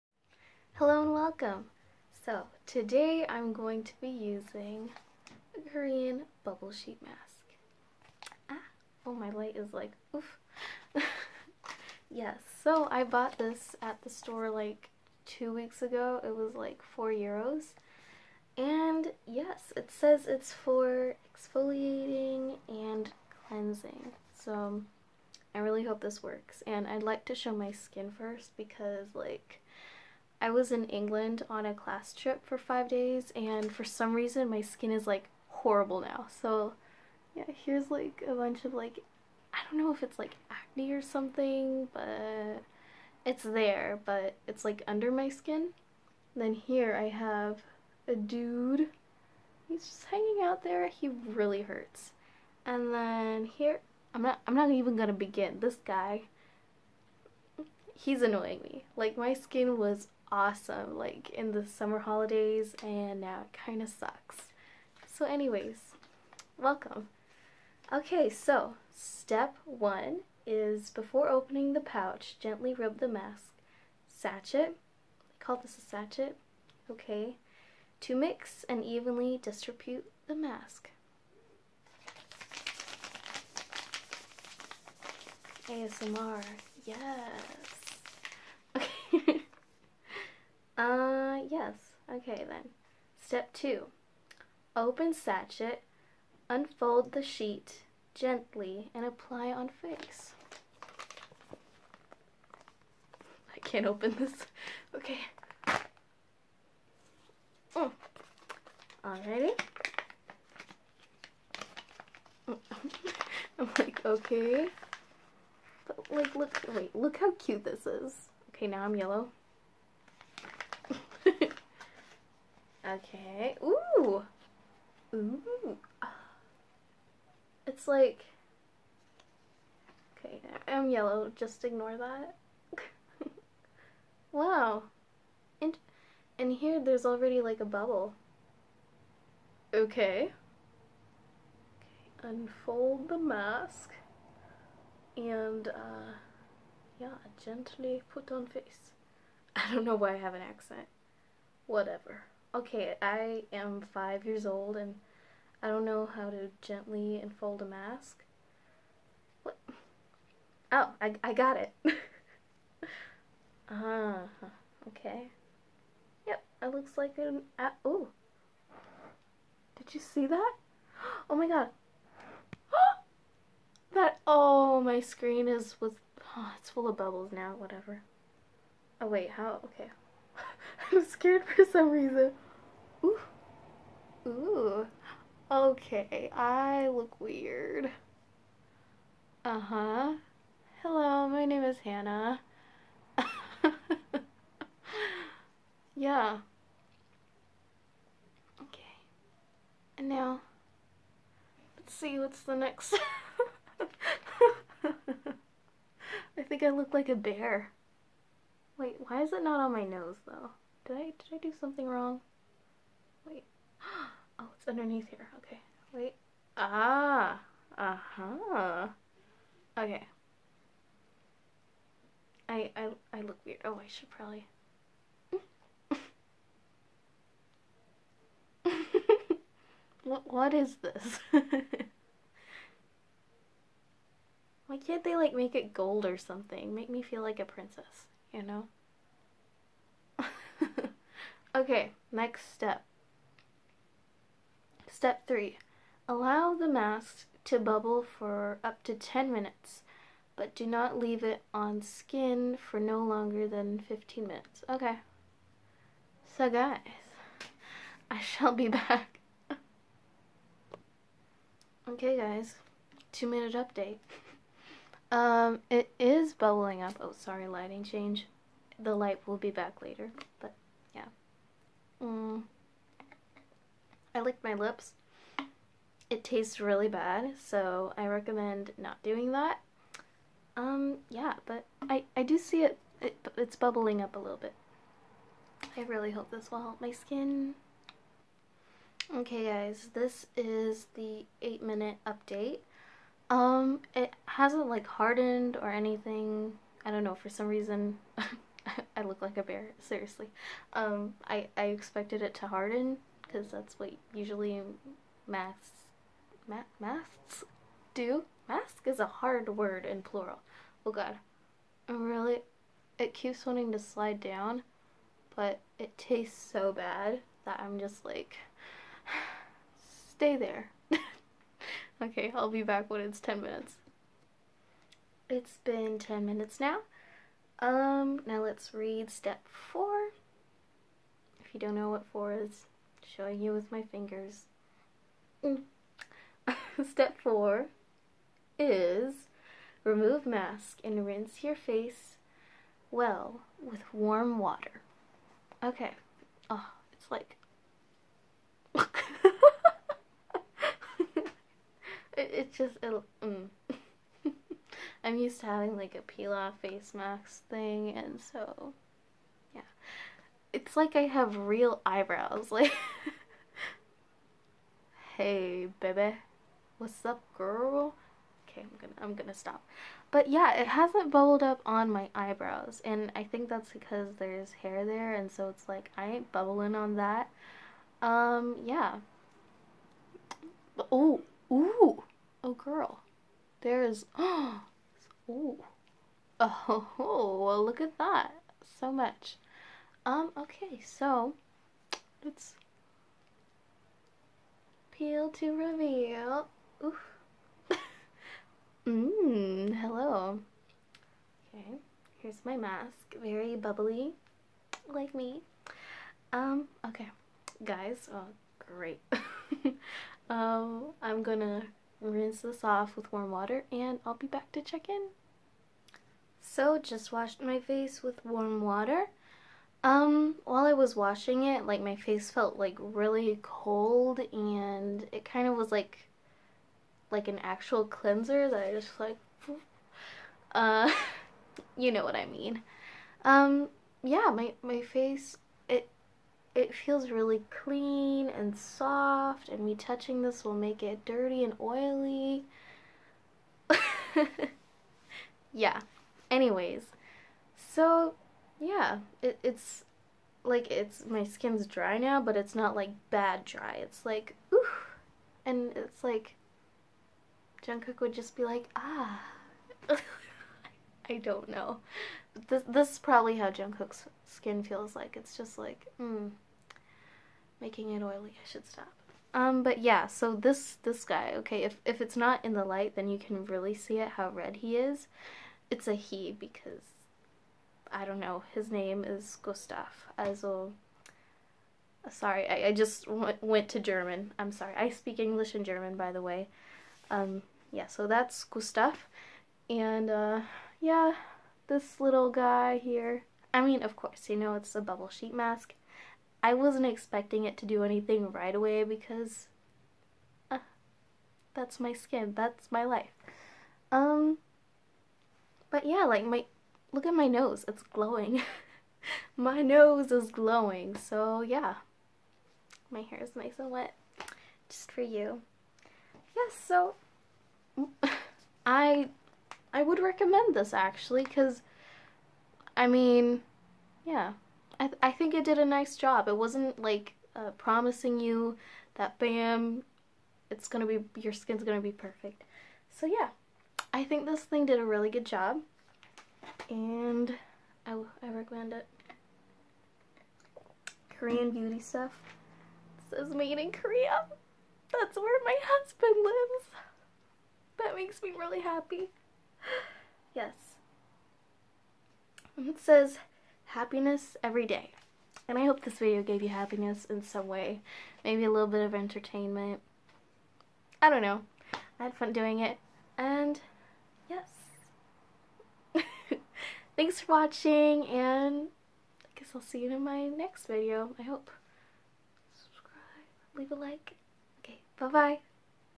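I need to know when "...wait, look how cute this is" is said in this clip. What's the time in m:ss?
1:56.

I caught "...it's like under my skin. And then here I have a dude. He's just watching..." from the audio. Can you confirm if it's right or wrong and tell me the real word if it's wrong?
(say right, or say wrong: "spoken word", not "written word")
wrong: "hanging", not "watching".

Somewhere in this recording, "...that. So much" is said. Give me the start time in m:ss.
6:27.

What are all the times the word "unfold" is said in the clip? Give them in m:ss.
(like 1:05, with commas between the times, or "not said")
1:36, 2:22, 2:37.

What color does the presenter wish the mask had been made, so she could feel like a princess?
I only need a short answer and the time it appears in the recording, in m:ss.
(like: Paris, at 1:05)
Gold, at 3:55.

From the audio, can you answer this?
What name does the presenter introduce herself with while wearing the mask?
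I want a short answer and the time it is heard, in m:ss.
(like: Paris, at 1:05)
Hannah, at 3:11.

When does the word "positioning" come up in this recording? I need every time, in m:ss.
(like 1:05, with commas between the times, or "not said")
not said.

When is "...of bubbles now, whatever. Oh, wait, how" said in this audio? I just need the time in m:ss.
2:56.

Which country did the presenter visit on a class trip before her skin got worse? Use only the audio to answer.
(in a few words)
England.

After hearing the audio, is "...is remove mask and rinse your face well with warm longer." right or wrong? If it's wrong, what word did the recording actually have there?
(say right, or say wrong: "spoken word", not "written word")
wrong: "water", not "longer".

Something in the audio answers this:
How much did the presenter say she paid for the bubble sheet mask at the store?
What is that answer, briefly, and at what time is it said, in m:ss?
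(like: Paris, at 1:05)
4 euros, at 0:16.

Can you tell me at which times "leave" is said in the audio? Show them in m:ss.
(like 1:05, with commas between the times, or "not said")
4:10, 9:33.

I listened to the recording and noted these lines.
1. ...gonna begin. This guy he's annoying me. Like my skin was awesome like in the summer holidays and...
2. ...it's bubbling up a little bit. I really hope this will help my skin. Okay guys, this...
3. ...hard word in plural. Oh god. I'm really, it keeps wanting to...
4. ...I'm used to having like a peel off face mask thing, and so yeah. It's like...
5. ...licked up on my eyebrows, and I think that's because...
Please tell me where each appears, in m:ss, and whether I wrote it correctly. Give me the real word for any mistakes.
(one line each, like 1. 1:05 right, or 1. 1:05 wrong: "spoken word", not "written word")
1. 0:54 right
2. 4:43 right
3. 5:09 right
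4. 5:55 right
5. 6:11 wrong: "bubbled", not "licked".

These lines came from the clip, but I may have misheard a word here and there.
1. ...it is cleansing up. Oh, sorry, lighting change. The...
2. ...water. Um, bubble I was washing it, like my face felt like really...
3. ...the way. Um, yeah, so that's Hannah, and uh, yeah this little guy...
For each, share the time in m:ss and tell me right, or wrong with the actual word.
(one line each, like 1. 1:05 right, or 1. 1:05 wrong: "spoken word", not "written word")
1. 4:25 wrong: "bubbling", not "cleansing"
2. 6:58 wrong: "while", not "bubble"
3. 8:06 wrong: "Gustav", not "Hannah".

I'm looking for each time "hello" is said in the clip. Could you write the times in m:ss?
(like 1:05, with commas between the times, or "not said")
0:00, 3:10, 6:39.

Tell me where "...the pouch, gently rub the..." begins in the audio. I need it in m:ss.
1:11.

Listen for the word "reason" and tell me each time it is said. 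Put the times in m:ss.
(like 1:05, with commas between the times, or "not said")
0:34, 3:01, 4:57.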